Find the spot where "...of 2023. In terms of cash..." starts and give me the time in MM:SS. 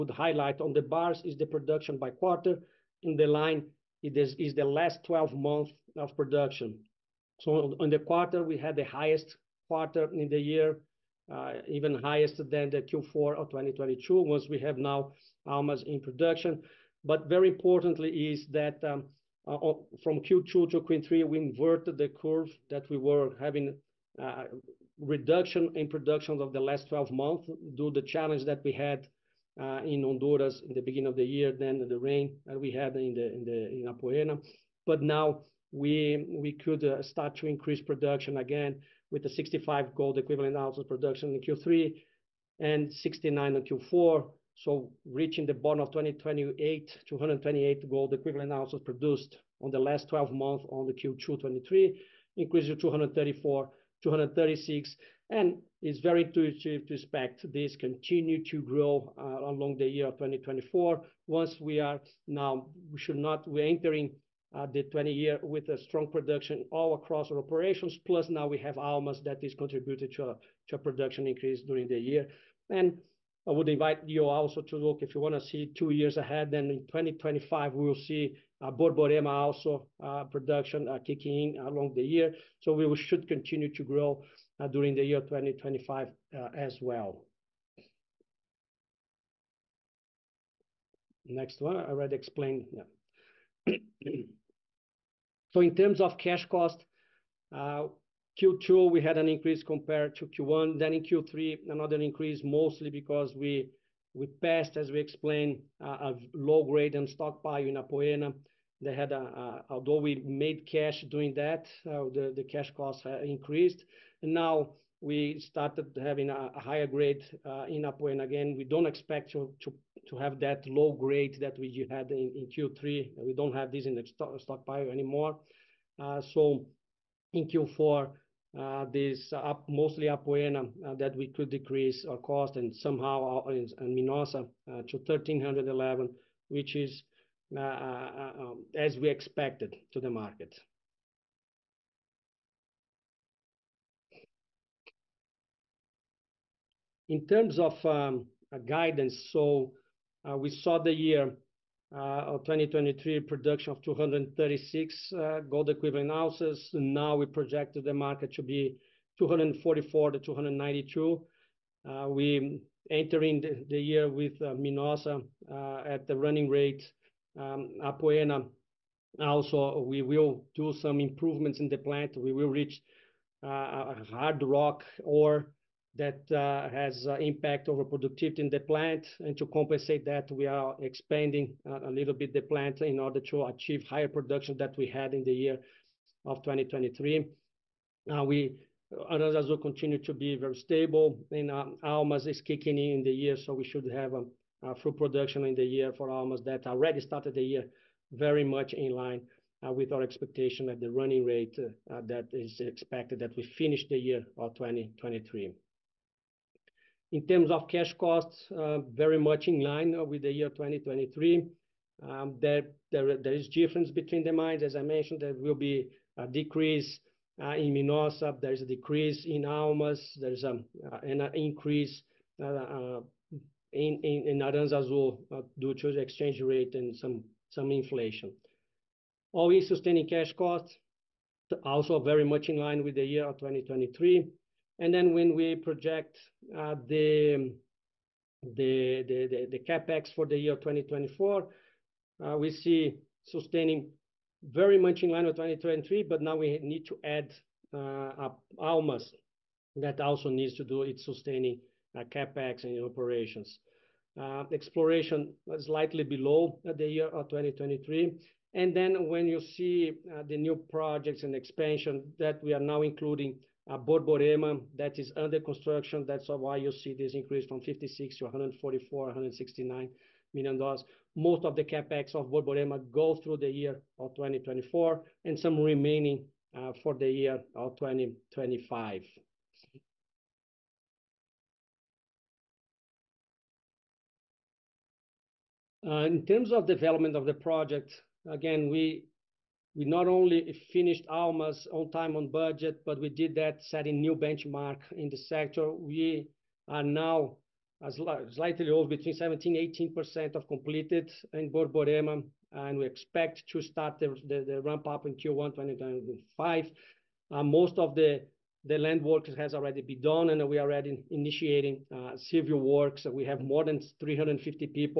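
03:24.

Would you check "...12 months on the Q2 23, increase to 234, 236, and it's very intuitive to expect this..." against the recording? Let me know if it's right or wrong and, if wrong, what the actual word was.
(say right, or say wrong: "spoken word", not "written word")
right.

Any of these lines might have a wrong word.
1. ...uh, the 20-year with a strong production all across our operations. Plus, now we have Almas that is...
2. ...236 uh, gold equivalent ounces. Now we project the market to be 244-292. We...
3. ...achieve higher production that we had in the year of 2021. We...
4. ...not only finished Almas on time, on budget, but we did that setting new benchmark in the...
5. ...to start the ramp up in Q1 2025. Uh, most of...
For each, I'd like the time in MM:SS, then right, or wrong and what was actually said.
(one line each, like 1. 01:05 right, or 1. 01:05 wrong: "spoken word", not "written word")
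1. 01:04 right
2. 02:33 right
3. 03:03 wrong: "2023", not "2021"
4. 04:49 right
5. 05:03 right.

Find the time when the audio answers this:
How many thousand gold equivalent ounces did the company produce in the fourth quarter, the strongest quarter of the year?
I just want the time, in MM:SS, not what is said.
00:42.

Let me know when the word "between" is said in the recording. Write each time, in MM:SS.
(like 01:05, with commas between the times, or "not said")
03:33, 04:58.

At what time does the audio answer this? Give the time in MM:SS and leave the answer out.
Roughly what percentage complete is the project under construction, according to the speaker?
04:59.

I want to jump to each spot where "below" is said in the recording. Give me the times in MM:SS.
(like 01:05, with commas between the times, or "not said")
04:16.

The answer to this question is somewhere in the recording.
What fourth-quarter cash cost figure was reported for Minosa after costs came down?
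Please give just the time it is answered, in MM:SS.
02:14.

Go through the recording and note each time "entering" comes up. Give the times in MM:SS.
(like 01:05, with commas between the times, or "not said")
01:03, 02:42.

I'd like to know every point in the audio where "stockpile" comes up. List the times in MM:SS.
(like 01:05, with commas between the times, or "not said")
01:47, 02:04.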